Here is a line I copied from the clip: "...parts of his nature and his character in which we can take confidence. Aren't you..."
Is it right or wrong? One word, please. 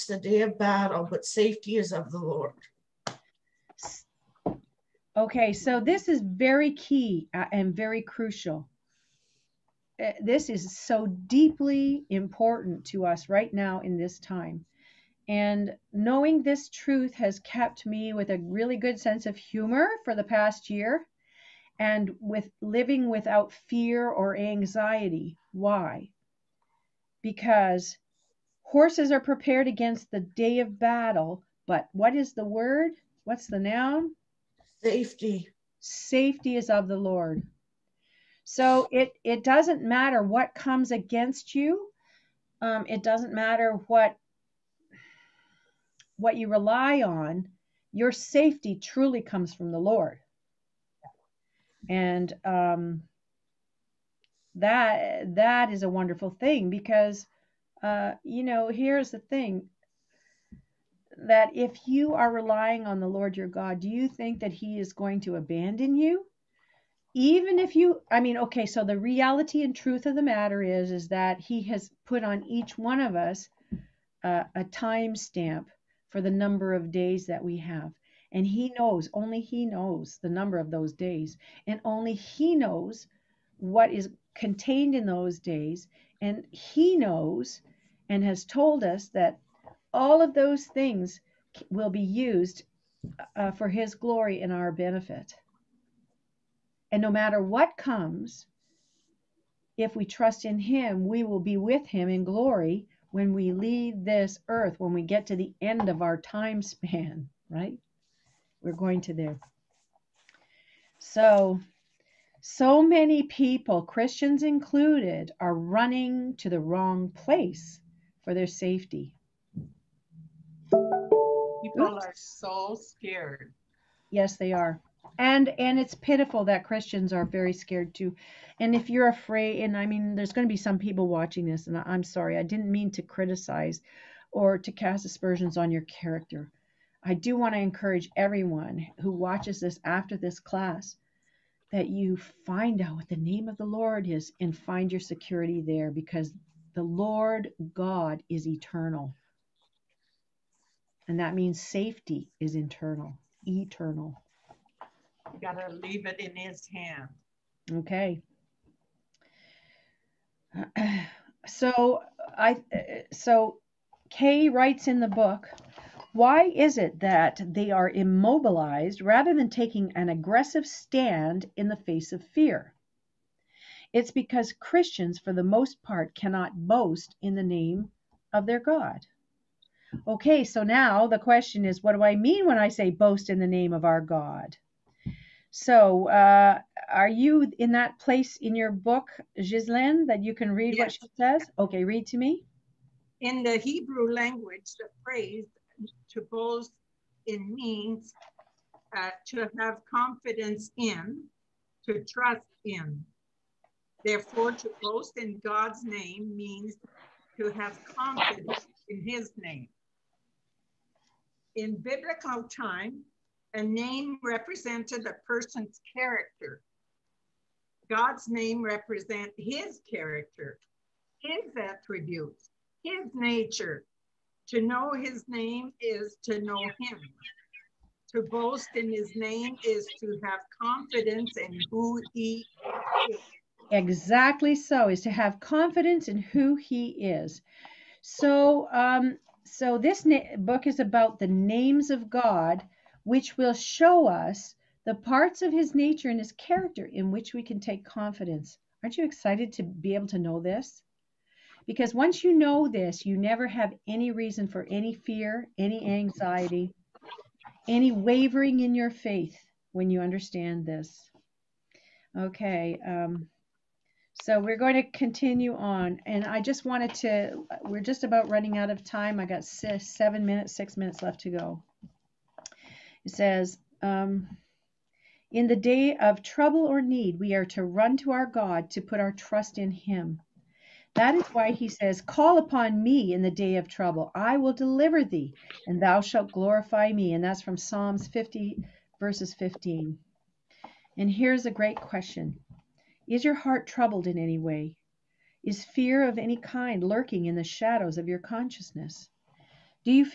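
right.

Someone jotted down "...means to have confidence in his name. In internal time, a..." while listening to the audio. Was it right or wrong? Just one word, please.
wrong.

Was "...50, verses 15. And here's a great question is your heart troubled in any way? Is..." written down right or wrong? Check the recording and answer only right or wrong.
right.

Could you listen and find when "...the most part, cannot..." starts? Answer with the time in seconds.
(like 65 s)
175 s.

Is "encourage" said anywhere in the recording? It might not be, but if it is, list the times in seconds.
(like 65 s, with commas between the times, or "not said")
137 s.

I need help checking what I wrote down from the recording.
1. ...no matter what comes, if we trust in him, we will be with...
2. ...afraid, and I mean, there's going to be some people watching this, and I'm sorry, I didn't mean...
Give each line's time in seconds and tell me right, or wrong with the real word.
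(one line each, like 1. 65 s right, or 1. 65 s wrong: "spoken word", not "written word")
1. 97 s right
2. 129 s right.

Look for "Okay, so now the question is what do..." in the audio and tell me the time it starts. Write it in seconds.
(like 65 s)
180 s.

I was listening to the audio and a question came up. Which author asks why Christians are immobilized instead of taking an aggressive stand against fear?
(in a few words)
Kay.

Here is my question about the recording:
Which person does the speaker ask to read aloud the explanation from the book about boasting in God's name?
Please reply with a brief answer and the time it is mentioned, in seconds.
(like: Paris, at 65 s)
Ghislaine, at 189 s.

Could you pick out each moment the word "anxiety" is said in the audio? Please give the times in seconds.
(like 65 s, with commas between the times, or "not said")
24 s, 255 s.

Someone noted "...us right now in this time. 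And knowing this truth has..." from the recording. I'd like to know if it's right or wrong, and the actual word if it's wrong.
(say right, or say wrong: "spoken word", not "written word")
right.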